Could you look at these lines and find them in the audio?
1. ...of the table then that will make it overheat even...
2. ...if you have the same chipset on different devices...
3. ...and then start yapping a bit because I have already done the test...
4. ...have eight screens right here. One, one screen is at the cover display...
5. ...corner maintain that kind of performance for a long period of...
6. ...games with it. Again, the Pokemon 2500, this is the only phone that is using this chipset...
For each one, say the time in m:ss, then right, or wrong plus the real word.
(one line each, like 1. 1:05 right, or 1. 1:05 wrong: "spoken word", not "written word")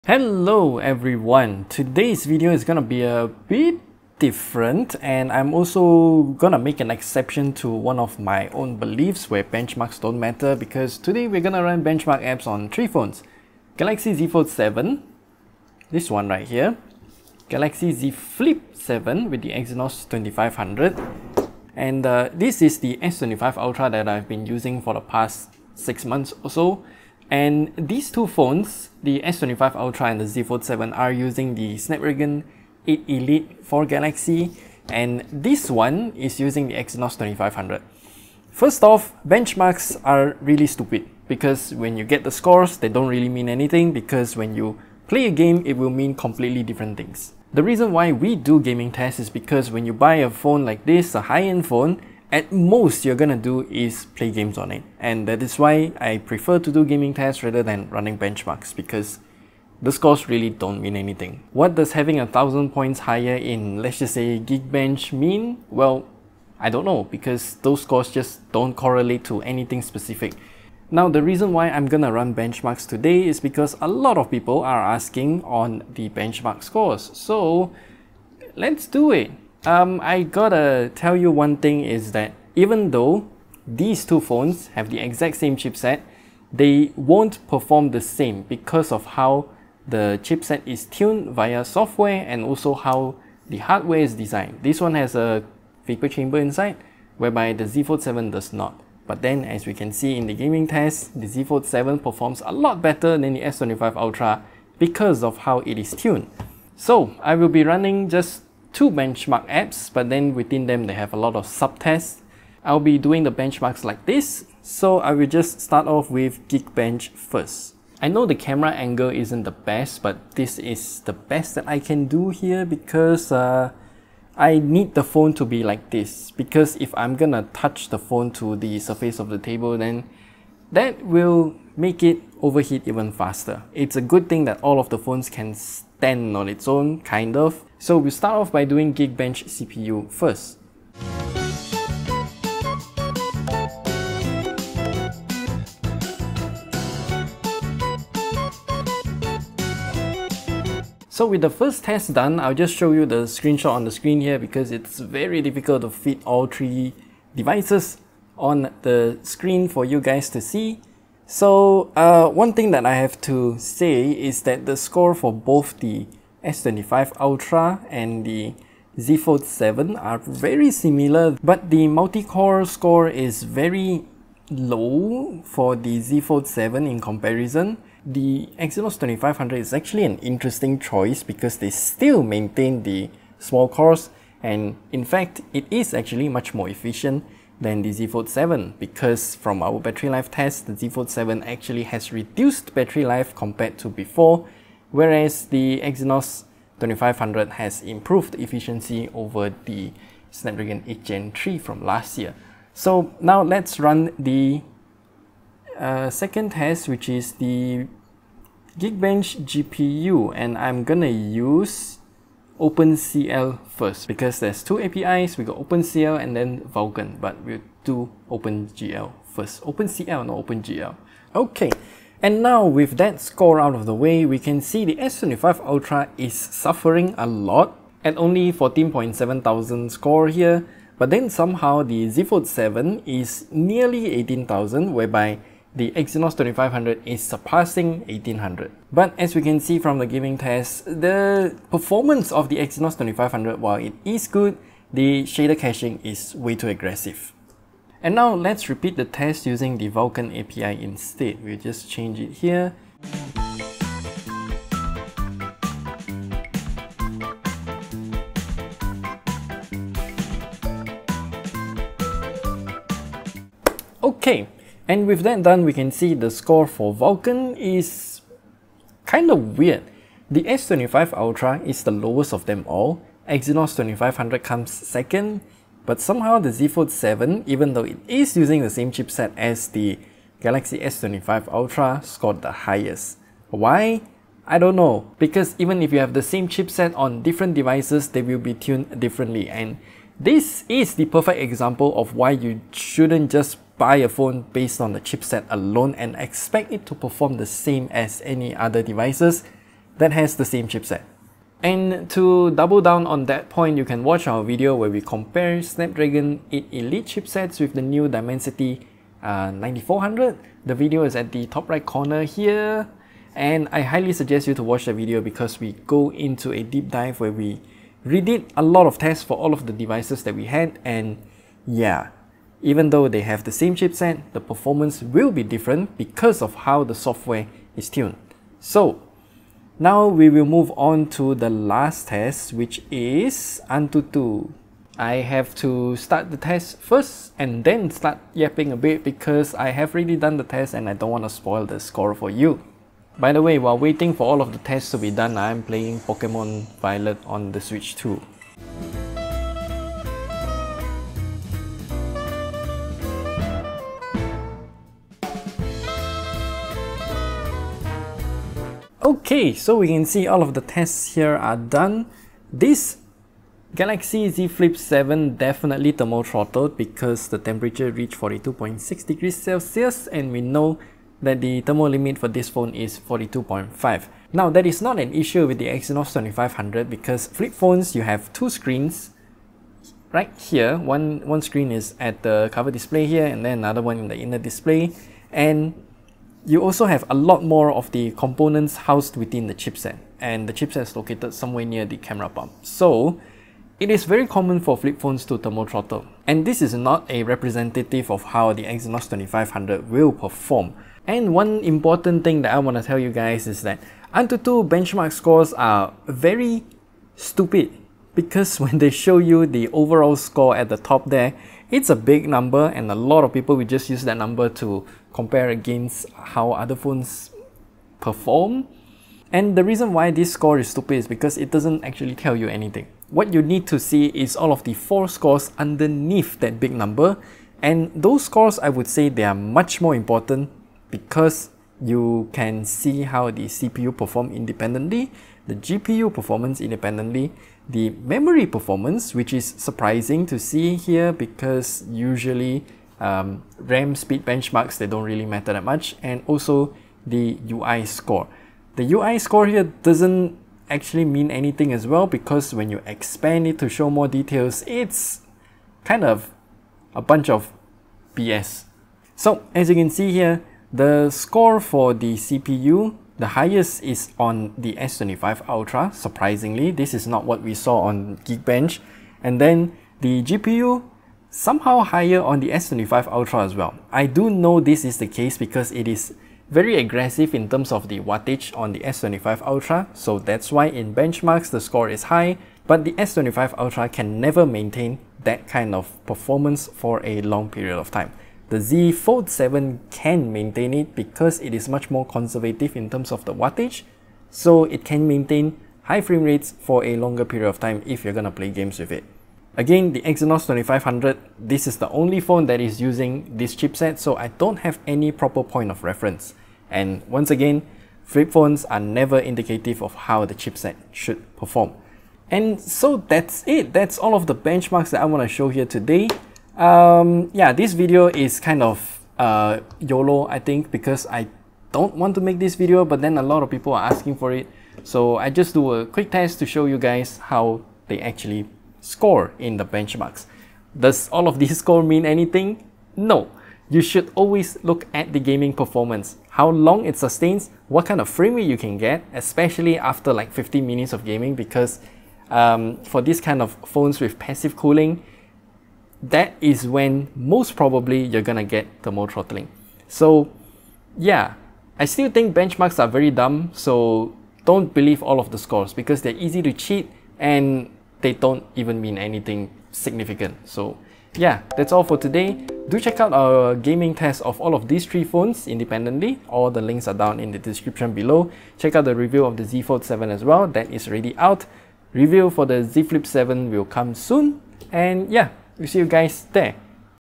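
1. 2:09 right
2. 4:45 right
3. 5:37 right
4. 6:18 wrong: "two", not "eight"
5. 8:04 wrong: "never", not "corner"
6. 8:18 wrong: "Exynos", not "Pokemon".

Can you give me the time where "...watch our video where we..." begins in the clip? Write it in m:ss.
5:04.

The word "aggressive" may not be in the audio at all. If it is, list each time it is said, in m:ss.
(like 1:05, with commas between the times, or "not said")
4:06, 7:56.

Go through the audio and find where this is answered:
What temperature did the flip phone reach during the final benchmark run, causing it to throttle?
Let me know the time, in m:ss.
6:08.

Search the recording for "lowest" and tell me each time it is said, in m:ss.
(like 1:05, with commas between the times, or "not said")
4:31.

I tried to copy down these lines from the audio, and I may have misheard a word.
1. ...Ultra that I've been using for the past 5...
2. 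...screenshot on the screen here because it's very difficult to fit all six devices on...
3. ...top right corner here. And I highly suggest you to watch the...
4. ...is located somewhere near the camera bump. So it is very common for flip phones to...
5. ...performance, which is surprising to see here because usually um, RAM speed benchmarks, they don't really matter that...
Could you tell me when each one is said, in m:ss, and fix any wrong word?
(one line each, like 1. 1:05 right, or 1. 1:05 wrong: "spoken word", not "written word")
1. 0:23 wrong: "6", not "5"
2. 2:33 wrong: "three", not "six"
3. 5:11 right
4. 6:30 right
5. 7:18 right.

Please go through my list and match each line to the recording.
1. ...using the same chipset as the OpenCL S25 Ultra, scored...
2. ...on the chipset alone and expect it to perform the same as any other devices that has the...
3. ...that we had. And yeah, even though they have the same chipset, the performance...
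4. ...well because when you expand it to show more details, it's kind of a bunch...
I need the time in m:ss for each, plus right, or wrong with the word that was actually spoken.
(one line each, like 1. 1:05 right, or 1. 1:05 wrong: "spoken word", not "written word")
1. 4:38 wrong: "Galaxy", not "OpenCL"
2. 4:54 right
3. 5:20 right
4. 7:31 right.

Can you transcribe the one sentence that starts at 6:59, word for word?
And the reason why this score is stupid is because it doesn't actually tell you anything.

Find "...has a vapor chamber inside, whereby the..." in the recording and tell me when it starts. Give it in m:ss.
1:34.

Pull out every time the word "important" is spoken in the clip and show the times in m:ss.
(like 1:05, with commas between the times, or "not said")
6:41, 7:09.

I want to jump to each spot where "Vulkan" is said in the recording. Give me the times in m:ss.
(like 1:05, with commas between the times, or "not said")
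3:36, 4:09, 4:26.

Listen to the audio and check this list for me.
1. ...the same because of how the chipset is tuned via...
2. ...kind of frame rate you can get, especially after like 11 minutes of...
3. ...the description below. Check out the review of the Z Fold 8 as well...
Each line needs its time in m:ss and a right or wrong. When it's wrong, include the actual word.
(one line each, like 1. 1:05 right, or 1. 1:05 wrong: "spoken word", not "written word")
1. 1:27 right
2. 8:57 wrong: "15", not "11"
3. 9:27 wrong: "7", not "8".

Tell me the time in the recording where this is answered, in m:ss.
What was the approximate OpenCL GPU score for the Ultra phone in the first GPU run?
3:48.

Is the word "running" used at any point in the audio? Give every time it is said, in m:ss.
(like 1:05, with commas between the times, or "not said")
0:57, 1:47.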